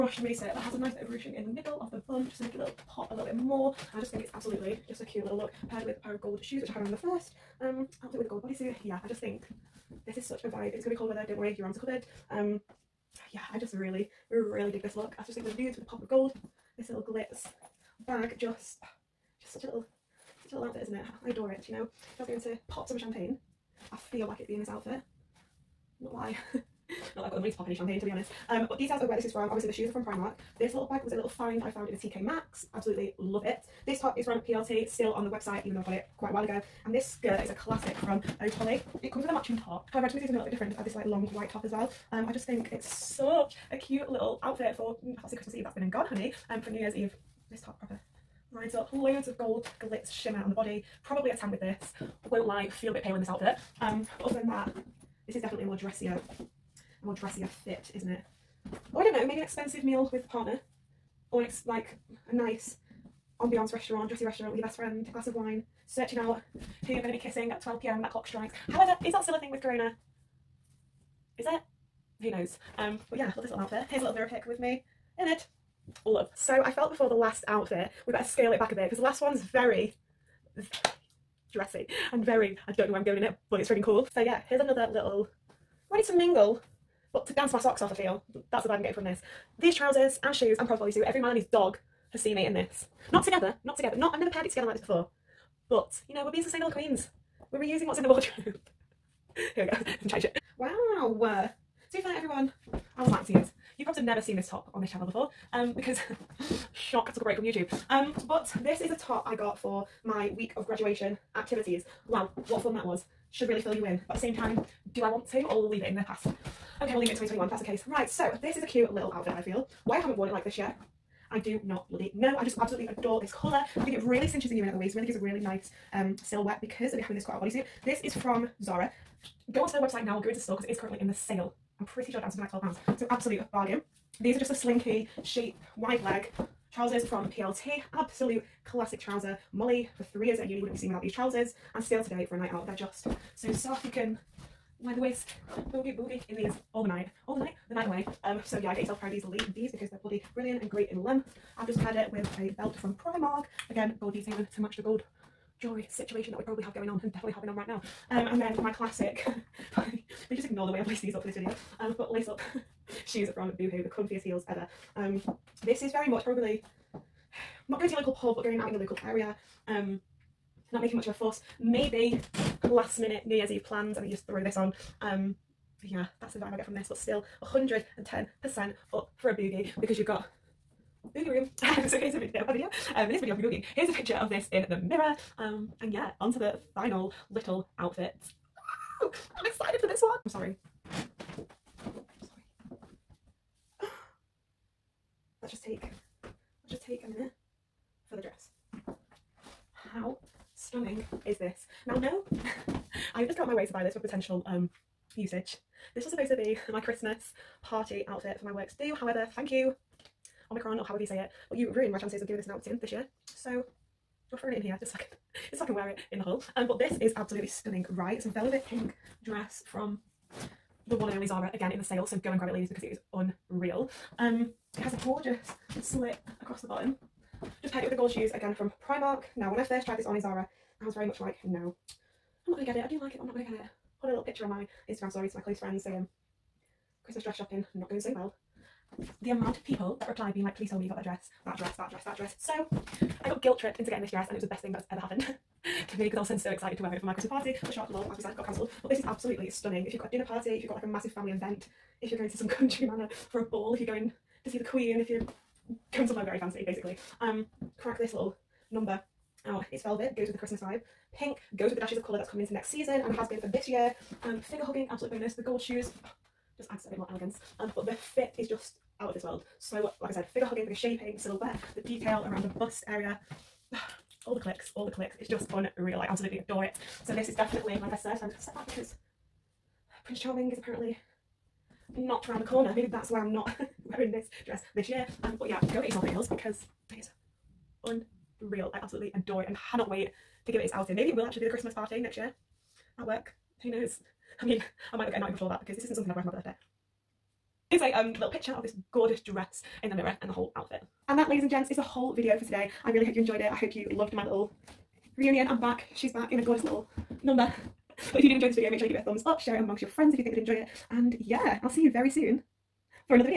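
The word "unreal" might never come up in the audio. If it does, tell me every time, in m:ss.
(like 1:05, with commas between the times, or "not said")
3:43, 4:35, 4:48.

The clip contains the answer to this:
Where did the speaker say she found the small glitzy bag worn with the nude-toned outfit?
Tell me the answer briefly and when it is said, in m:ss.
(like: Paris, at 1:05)
TK Maxx, at 0:31.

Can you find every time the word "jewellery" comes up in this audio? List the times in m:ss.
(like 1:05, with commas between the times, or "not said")
2:35.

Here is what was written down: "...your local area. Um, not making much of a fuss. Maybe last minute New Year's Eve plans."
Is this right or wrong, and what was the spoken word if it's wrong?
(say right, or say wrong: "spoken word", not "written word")
right.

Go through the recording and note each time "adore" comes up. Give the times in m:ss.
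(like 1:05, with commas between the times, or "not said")
0:21, 2:02, 4:36, 4:49.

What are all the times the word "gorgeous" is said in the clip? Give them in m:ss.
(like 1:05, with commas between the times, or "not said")
3:45, 4:58, 5:06.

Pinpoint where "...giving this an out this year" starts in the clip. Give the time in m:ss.
3:32.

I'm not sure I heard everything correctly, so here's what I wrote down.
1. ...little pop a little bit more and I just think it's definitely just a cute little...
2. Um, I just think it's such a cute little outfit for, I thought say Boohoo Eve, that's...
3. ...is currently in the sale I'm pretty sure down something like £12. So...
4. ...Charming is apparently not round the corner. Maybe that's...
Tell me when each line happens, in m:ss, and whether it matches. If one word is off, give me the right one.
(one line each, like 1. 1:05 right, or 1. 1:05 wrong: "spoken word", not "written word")
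1. 0:02 wrong: "absolutely", not "definitely"
2. 0:42 wrong: "Christmas", not "Boohoo"
3. 2:10 right
4. 4:40 right.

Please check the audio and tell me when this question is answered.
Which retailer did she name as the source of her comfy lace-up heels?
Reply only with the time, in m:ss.
2:43.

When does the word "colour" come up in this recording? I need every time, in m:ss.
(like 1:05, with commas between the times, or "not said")
2:03, 4:22.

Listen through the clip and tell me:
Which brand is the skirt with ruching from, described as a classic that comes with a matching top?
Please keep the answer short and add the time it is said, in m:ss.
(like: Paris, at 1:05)
Ode, at 0:38.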